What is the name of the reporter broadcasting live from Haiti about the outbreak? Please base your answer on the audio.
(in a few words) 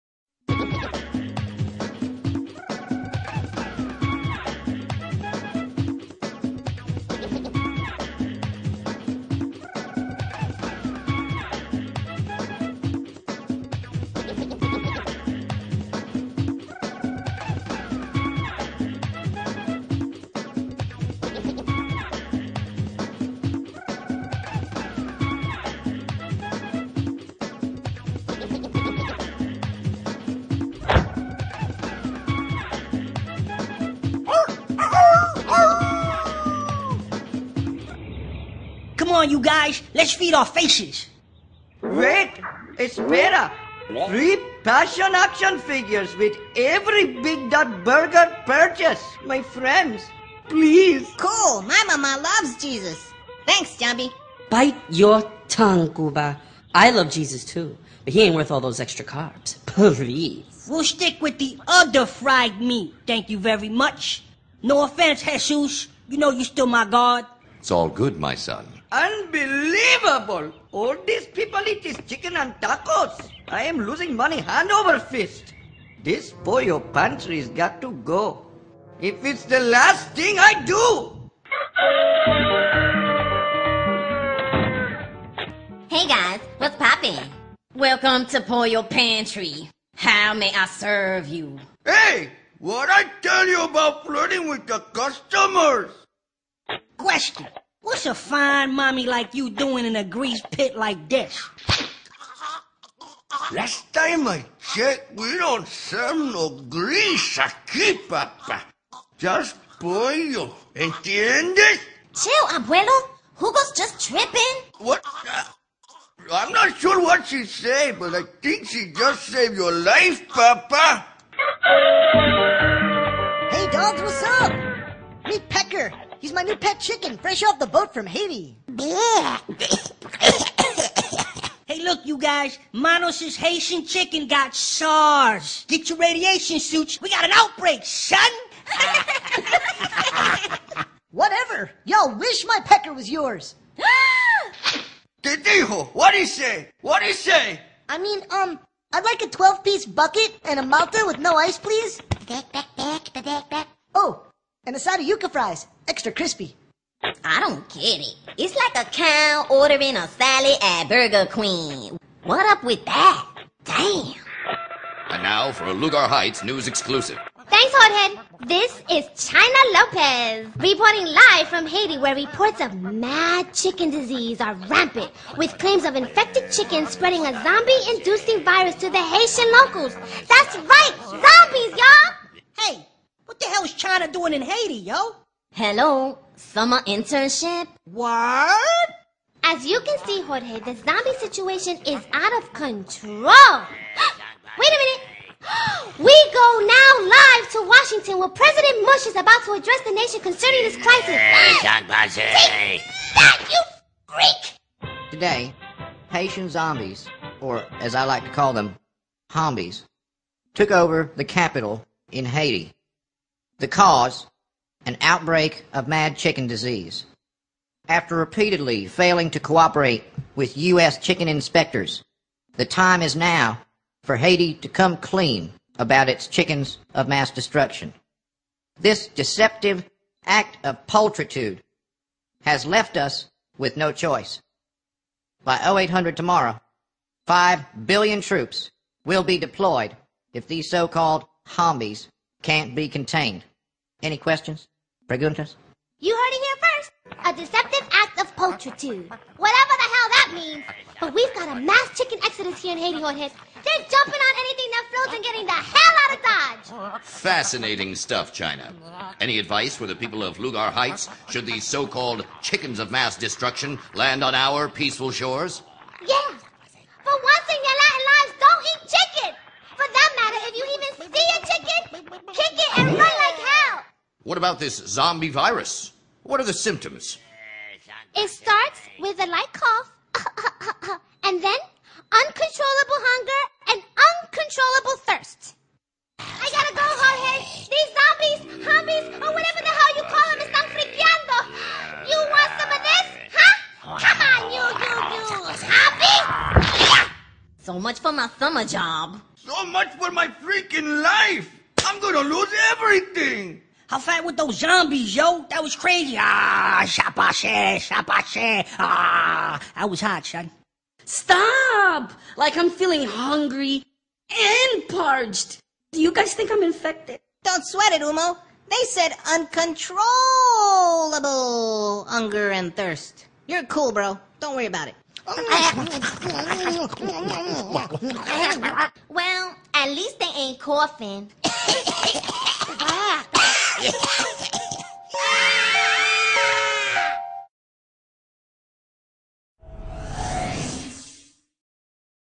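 China Lopez.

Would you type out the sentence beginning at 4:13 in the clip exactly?
They're jumping on anything that floats and getting the hell out of Dodge.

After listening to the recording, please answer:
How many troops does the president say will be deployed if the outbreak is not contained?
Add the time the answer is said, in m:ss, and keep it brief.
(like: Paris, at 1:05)
5 billion, at 3:57.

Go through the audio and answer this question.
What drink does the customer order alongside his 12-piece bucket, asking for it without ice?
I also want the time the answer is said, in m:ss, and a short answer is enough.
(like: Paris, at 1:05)
Malta, at 2:30.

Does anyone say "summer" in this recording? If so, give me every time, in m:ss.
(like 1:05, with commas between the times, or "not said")
3:06, 4:58.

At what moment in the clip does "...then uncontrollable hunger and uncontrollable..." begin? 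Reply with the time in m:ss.
4:41.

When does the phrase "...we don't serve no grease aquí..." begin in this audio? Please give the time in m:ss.
1:45.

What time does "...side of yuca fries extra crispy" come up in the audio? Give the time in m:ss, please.
2:34.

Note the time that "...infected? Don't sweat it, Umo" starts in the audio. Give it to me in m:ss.
5:16.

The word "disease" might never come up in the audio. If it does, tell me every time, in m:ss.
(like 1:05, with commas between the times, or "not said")
2:53, 3:36.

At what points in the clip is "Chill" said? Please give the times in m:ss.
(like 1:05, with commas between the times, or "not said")
1:52.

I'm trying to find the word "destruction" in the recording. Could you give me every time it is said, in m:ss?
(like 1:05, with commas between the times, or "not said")
3:47, 4:23.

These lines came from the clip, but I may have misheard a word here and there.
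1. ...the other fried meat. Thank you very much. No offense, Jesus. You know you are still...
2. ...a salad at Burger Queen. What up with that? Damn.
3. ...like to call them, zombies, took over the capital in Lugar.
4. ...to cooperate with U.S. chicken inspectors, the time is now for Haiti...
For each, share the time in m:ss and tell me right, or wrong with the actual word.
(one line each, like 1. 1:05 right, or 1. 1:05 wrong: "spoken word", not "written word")
1. 1:01 right
2. 2:39 right
3. 3:28 wrong: "Haiti", not "Lugar"
4. 3:39 right.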